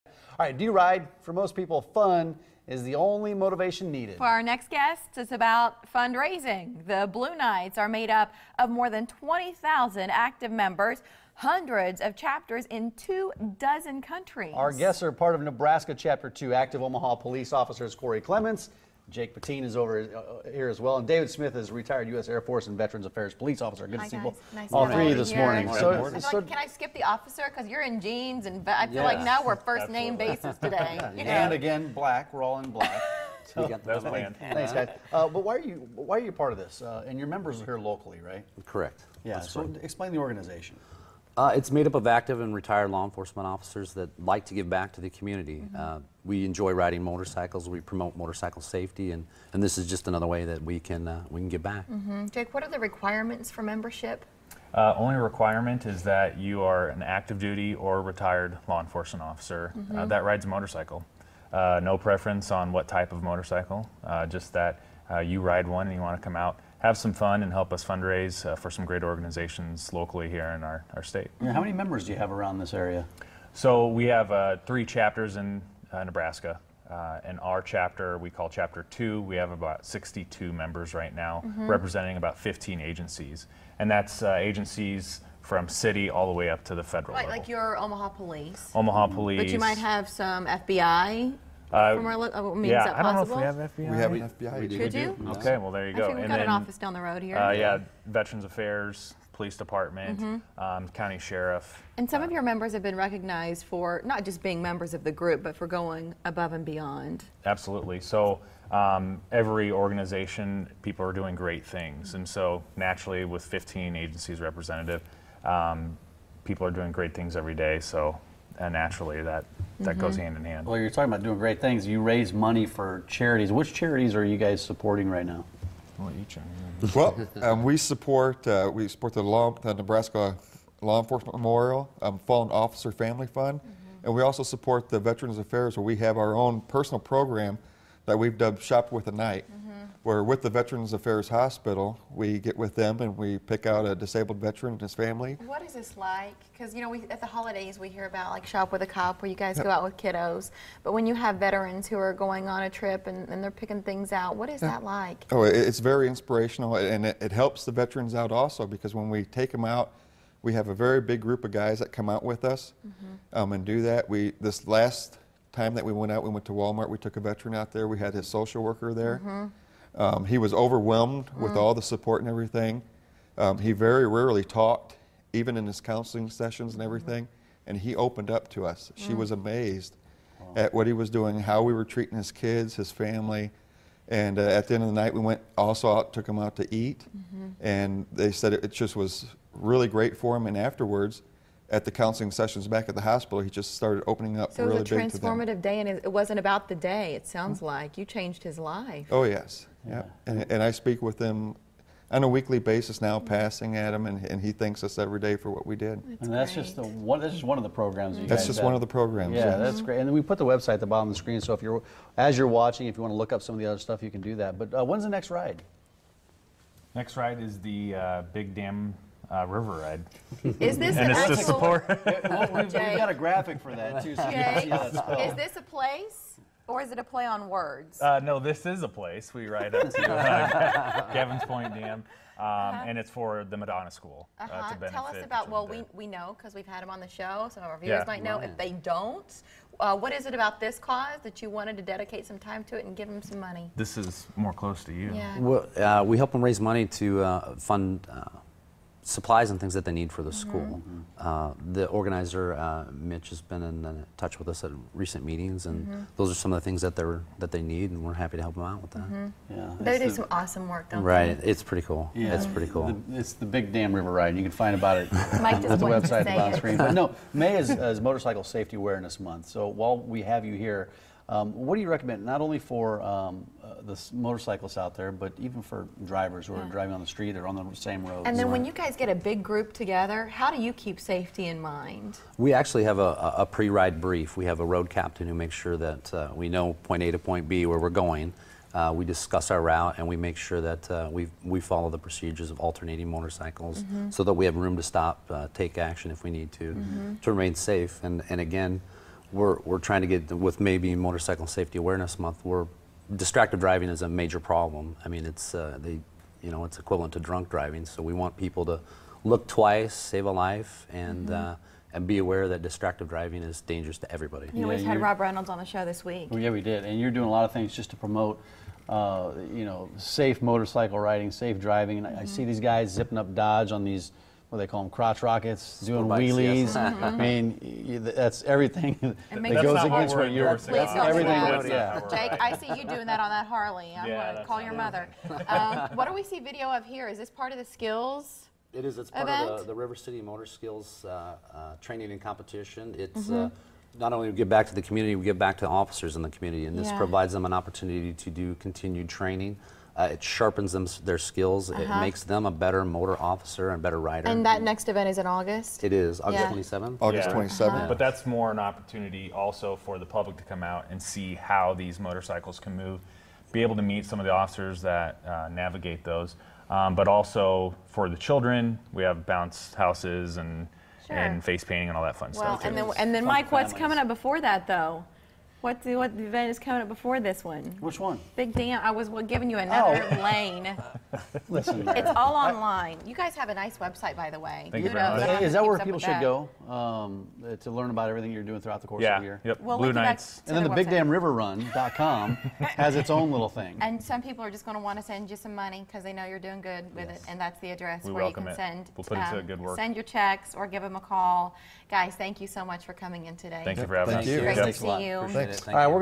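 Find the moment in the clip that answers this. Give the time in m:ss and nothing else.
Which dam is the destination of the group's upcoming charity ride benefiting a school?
3:51.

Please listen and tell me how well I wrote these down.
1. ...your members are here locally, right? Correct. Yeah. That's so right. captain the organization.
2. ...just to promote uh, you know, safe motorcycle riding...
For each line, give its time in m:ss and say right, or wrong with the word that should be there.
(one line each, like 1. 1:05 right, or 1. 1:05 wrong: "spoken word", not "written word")
1. 0:37 wrong: "explain", not "captain"
2. 5:17 right.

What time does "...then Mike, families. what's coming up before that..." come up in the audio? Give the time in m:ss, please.
6:13.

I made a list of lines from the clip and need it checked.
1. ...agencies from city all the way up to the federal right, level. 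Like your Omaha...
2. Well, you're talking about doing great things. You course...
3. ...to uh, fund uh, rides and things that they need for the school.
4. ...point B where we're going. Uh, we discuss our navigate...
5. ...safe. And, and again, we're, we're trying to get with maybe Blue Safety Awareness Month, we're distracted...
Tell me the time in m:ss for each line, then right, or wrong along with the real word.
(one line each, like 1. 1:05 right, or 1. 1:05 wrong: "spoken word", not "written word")
1. 1:24 right
2. 2:00 wrong: "raise", not "course"
3. 4:06 wrong: "supplies", not "rides"
4. 4:47 wrong: "route", not "navigate"
5. 4:57 wrong: "Motorcycle", not "Blue".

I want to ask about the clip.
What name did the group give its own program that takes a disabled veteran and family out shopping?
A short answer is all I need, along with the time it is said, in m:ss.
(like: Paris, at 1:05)
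Shop with a Knight, at 2:18.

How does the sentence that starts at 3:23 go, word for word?
passing at him, and, and he thanks us every day for what we did.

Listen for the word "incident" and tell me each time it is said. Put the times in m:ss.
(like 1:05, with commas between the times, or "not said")
not said.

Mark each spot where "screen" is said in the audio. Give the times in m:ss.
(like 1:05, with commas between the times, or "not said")
3:31, 4:26.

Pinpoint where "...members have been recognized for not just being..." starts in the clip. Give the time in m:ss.
1:42.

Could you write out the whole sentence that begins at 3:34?
But uh, when's the next ride?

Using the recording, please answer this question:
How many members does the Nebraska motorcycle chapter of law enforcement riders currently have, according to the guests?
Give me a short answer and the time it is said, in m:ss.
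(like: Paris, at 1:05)
62, at 1:19.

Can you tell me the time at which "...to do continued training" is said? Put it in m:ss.
5:48.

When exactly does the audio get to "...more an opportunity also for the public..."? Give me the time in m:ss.
5:58.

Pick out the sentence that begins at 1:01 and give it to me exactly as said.
Uh, no preference on what type of motorcycle.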